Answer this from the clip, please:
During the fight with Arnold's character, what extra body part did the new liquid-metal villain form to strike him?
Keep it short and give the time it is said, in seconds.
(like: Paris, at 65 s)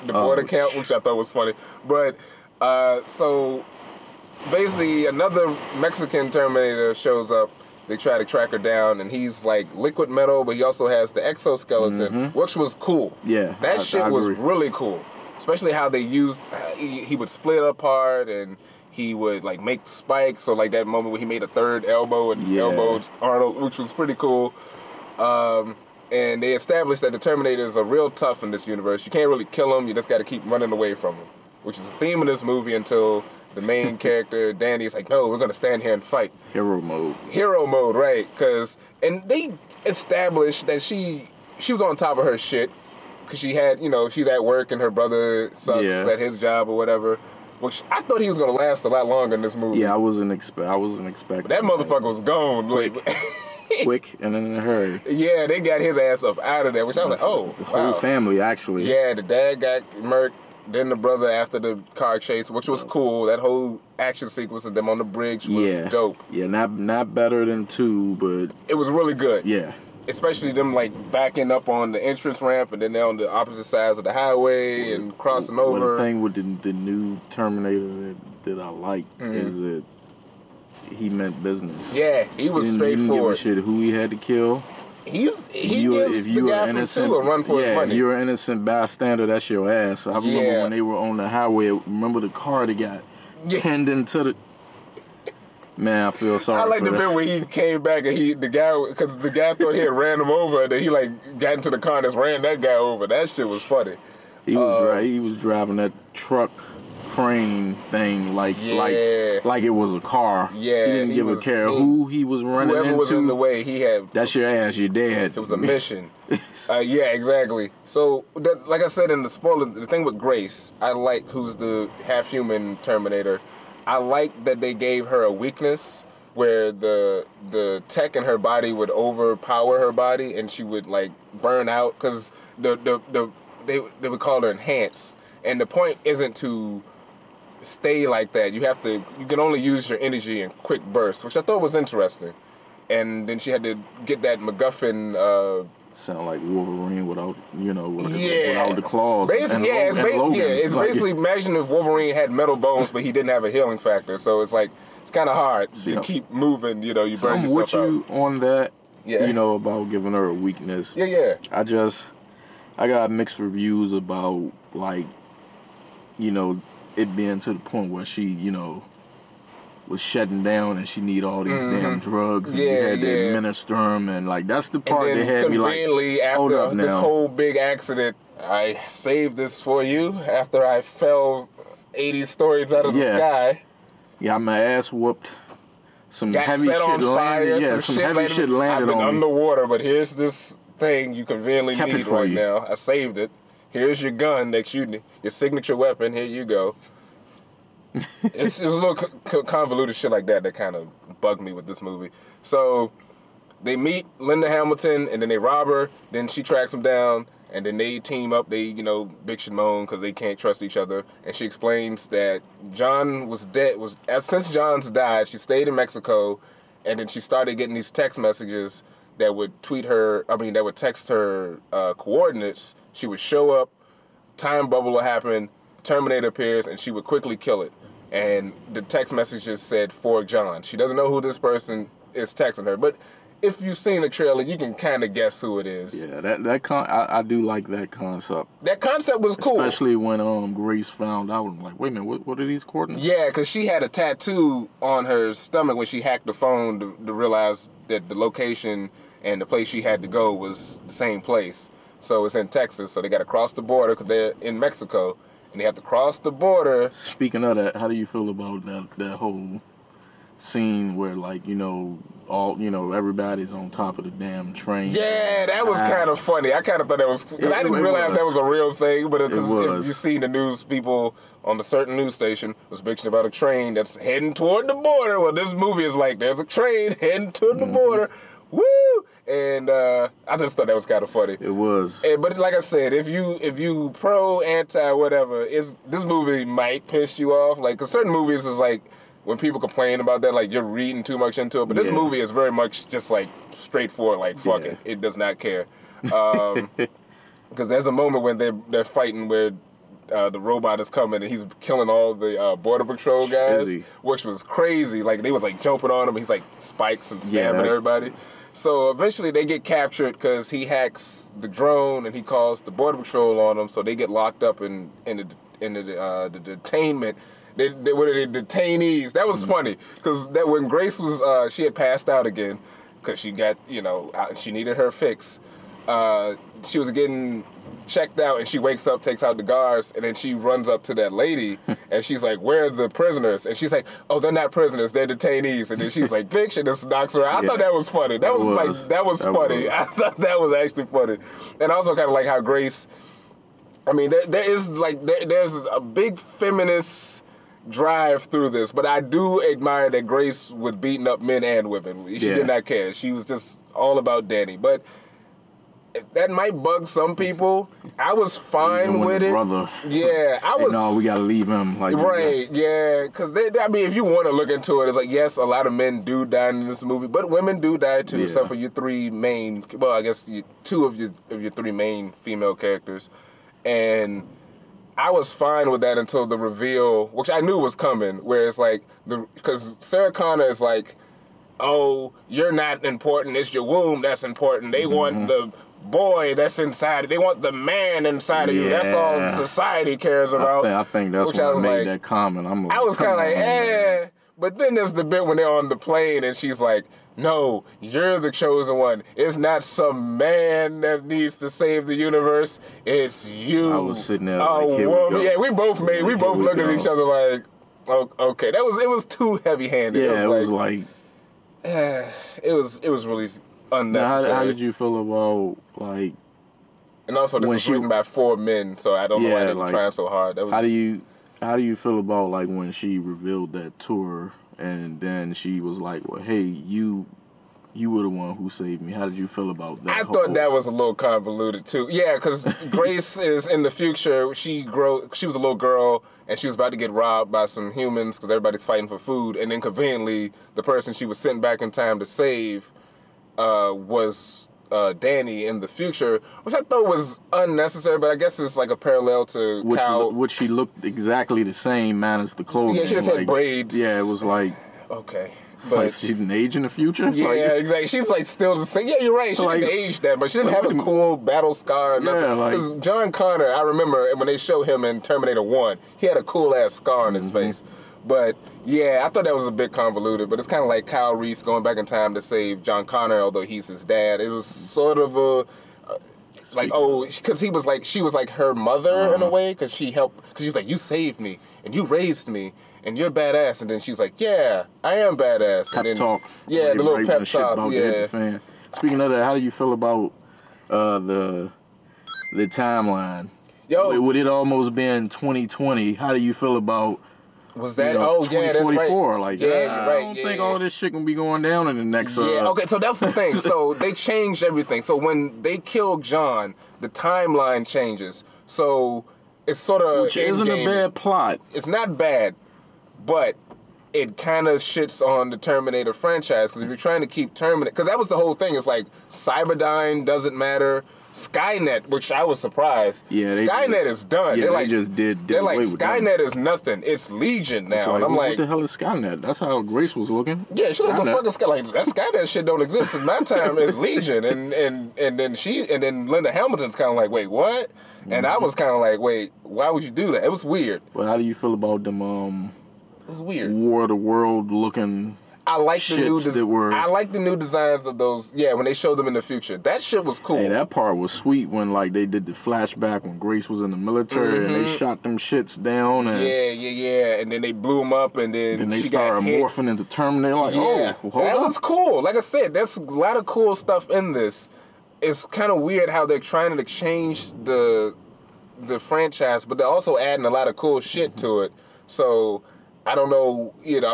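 third elbow, at 21 s.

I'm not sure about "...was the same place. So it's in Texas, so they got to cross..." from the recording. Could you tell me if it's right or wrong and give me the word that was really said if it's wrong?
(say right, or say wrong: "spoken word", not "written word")
right.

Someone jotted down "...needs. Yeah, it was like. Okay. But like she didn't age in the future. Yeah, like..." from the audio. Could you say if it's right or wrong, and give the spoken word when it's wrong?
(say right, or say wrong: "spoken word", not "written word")
wrong: "braids", not "needs".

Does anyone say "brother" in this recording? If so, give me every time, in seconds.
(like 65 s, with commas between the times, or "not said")
44 s, 60 s, 359 s.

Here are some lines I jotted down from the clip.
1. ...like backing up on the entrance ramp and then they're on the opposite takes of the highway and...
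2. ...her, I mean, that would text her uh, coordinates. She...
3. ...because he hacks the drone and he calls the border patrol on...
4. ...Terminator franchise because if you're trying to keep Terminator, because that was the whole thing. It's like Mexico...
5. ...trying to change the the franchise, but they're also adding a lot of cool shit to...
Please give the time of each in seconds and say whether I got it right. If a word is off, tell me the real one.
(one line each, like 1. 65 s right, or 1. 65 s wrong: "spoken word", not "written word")
1. 70 s wrong: "sides", not "takes"
2. 219 s right
3. 310 s right
4. 515 s wrong: "Cyberdyne", not "Mexico"
5. 566 s right.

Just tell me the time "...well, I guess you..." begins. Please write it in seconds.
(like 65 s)
369 s.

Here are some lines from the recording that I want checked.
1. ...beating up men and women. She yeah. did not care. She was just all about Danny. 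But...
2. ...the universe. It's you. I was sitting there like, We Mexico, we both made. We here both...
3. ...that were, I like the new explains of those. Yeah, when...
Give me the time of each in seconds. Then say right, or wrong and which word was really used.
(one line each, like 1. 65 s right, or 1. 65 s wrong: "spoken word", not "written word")
1. 350 s right
2. 401 s wrong: "Yeah", not "Mexico"
3. 546 s wrong: "designs", not "explains".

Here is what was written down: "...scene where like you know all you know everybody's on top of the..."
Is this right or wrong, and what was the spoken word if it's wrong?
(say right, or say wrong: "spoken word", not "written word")
right.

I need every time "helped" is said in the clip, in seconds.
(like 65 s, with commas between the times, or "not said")
479 s.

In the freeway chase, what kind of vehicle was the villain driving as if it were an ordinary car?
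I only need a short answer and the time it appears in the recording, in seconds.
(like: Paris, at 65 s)
truck crane, at 106 s.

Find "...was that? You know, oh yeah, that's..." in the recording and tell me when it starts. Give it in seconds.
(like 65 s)
497 s.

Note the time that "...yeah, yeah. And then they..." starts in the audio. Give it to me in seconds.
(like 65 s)
556 s.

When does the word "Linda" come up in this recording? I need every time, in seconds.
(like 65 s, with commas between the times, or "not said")
204 s, 536 s.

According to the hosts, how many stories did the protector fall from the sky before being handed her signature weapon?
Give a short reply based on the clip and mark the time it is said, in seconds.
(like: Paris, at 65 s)
80, at 181 s.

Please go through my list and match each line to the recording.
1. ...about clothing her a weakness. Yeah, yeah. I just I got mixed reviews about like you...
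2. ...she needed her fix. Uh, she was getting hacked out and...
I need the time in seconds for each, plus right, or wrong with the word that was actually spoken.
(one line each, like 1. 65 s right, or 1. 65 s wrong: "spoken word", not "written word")
1. 159 s wrong: "giving", not "clothing"
2. 324 s wrong: "checked", not "hacked".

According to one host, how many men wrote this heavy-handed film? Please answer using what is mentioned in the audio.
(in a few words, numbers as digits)
4.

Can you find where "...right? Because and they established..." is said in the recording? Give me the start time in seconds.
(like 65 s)
37 s.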